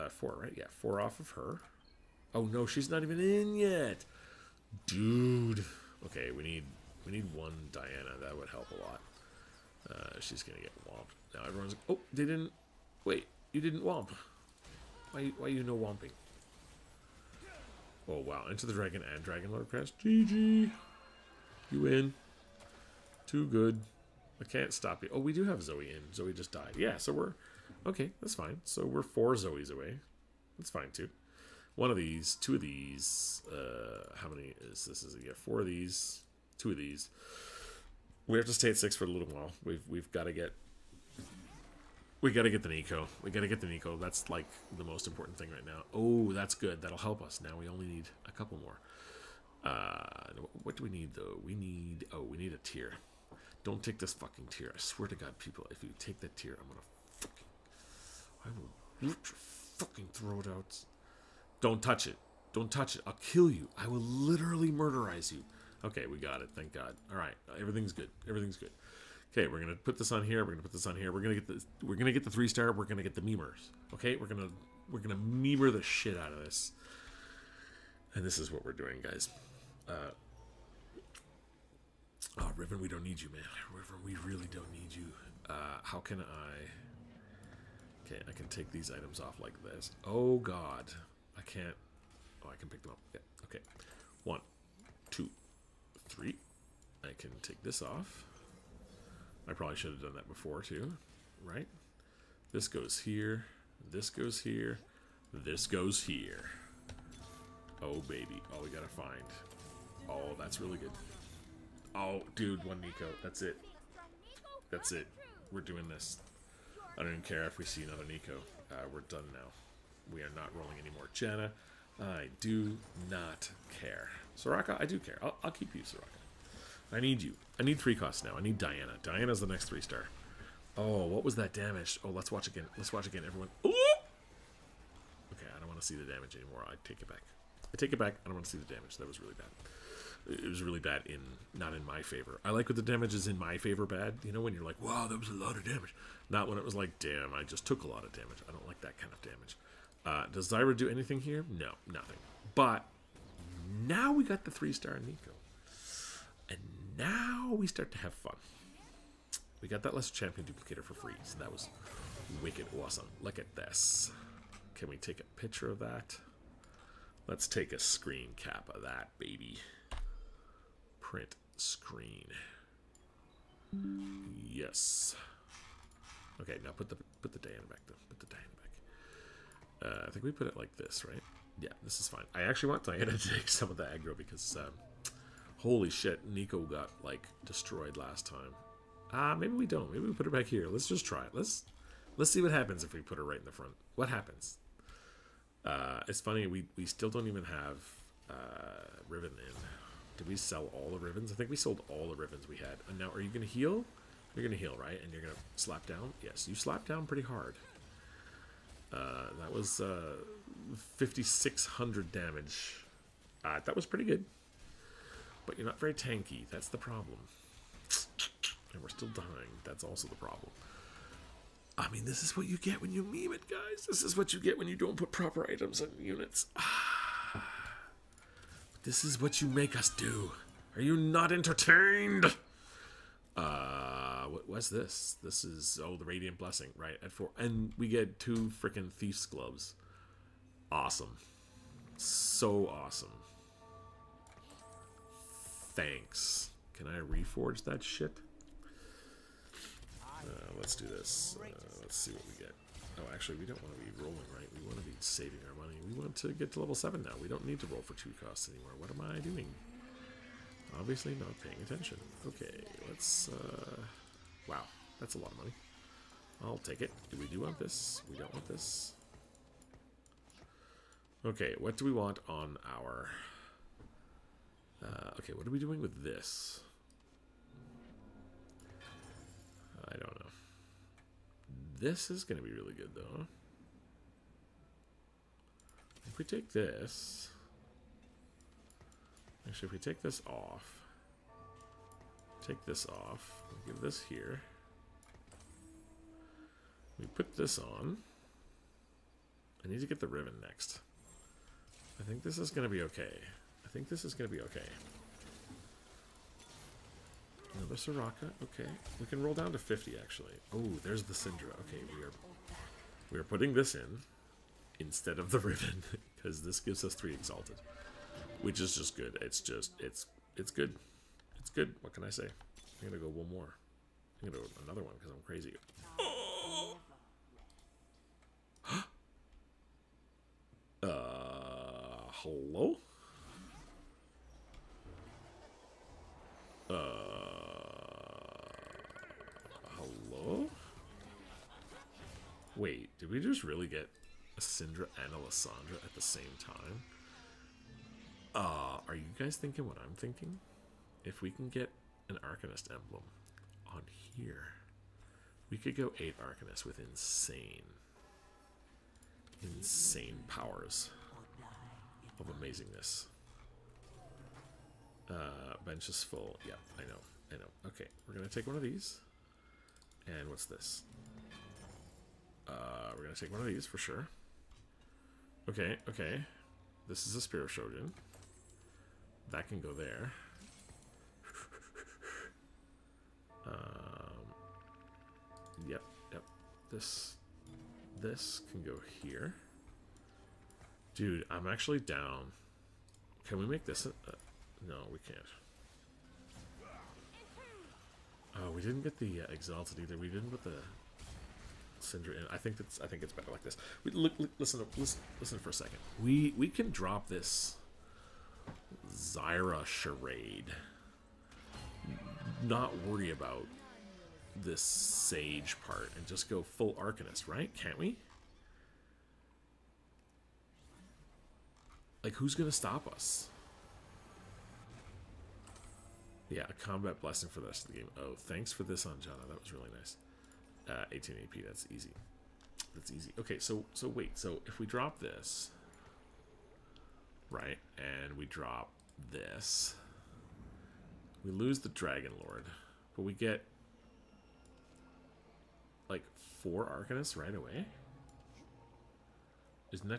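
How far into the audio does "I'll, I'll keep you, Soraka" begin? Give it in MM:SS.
02:05.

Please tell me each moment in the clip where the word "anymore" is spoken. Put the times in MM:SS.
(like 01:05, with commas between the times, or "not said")
02:16, 04:18.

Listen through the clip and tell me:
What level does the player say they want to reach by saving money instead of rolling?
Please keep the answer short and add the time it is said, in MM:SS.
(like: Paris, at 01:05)
7, at 04:16.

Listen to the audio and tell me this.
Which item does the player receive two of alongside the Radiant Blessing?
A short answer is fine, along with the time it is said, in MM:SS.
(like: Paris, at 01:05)
Thief's Gloves, at 03:58.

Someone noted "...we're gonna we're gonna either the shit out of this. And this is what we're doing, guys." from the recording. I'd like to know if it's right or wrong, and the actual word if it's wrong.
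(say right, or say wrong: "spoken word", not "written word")
wrong: "memer", not "either".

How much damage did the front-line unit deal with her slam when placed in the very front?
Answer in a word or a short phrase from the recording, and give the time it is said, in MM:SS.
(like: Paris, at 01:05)
5,600, at 03:30.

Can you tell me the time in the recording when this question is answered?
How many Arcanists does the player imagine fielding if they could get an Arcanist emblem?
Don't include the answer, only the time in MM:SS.
05:55.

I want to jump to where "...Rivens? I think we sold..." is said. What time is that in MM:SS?
03:21.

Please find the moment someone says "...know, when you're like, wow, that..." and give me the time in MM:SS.
02:24.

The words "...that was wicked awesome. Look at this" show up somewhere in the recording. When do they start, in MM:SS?
02:41.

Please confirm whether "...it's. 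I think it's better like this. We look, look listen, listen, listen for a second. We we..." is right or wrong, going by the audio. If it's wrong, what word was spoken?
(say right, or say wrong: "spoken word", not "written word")
right.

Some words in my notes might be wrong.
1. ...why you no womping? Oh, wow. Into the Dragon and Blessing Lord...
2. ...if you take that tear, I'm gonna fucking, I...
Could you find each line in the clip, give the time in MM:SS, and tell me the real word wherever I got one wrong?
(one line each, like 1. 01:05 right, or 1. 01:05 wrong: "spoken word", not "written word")
1. 00:15 wrong: "Dragon", not "Blessing"
2. 00:55 right.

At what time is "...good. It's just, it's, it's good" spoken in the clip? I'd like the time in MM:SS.
05:18.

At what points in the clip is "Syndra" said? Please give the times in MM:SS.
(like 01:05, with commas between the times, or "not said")
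05:11, 05:44, 06:41.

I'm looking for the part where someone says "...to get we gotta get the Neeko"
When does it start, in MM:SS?
00:40.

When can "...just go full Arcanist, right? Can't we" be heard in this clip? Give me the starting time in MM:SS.
06:56.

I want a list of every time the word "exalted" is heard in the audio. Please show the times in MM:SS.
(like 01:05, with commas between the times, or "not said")
05:17, 06:39.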